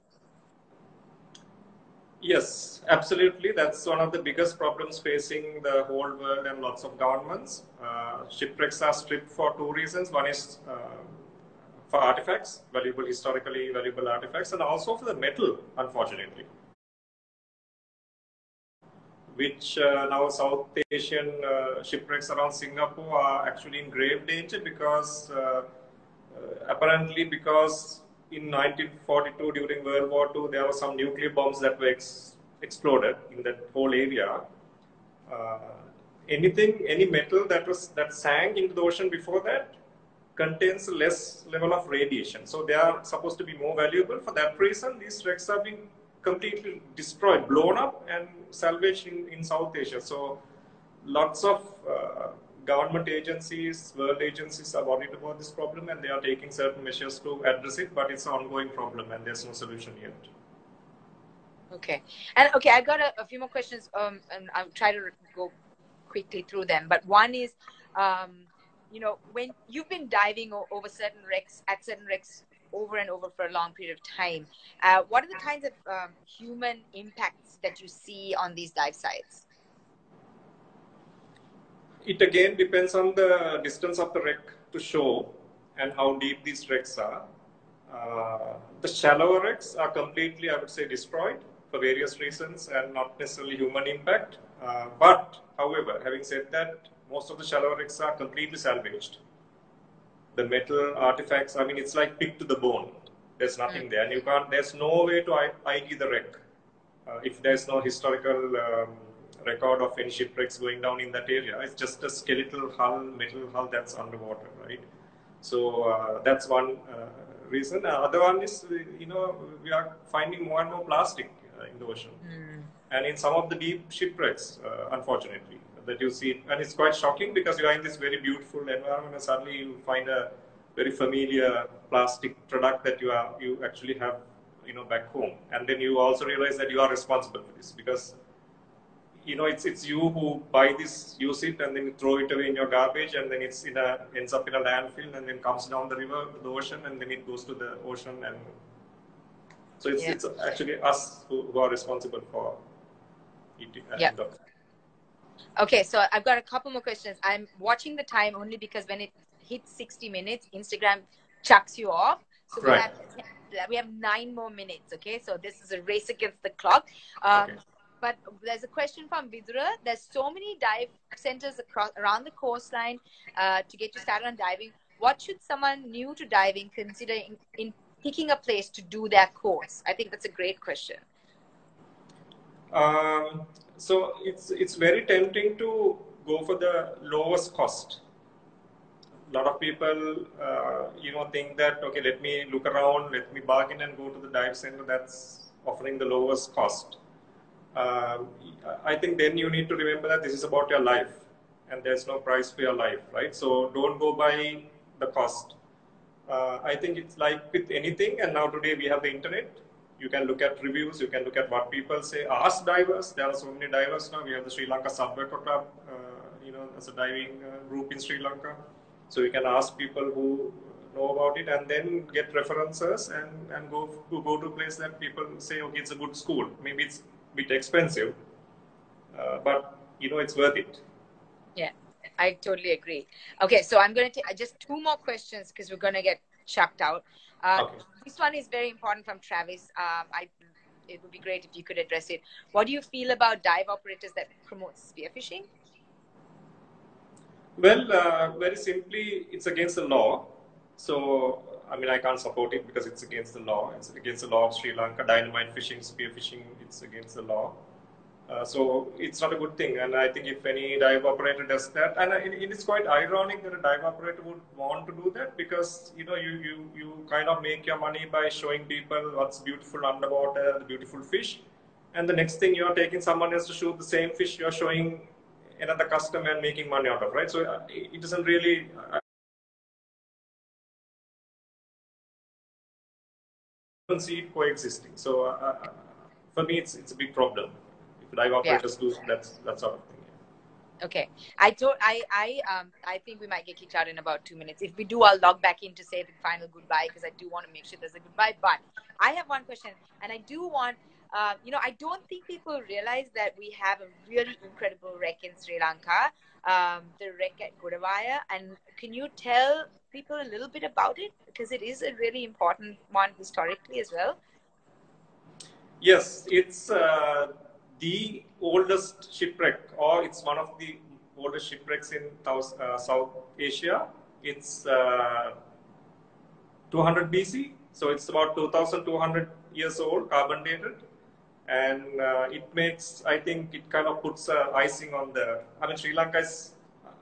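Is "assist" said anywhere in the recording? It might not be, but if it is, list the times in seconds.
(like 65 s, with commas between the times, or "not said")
not said.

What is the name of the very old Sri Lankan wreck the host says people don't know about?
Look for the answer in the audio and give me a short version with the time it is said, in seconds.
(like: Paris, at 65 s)
Godawaya, at 307 s.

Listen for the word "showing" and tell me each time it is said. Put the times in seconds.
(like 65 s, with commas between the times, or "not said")
268 s, 274 s.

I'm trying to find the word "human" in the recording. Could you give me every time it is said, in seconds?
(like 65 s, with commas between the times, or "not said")
76 s, 93 s.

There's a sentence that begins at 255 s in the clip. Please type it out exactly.
Dynamite fishing, spearfishing, it's against the law.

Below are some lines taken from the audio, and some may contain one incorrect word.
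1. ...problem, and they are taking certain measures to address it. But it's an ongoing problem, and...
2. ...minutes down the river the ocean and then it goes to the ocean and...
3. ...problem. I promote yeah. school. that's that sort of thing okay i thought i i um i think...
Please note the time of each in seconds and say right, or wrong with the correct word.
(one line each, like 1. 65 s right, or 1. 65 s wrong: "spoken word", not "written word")
1. 55 s right
2. 145 s wrong: "comes", not "minutes"
3. 287 s wrong: "operate", not "promote".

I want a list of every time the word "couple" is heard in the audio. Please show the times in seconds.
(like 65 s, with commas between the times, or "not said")
156 s.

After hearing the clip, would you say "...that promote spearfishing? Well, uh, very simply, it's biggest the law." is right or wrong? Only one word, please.
wrong.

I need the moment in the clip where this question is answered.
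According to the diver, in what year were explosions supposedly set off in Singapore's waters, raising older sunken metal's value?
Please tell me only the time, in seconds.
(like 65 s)
28 s.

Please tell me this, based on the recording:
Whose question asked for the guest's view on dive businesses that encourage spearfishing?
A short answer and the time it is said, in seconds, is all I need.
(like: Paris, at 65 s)
Travis, at 239 s.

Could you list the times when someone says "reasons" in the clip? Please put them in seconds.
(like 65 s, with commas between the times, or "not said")
9 s, 44 s, 92 s, 117 s.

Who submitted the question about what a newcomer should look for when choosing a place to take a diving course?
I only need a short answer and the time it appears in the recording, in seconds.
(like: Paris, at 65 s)
Vidura, at 169 s.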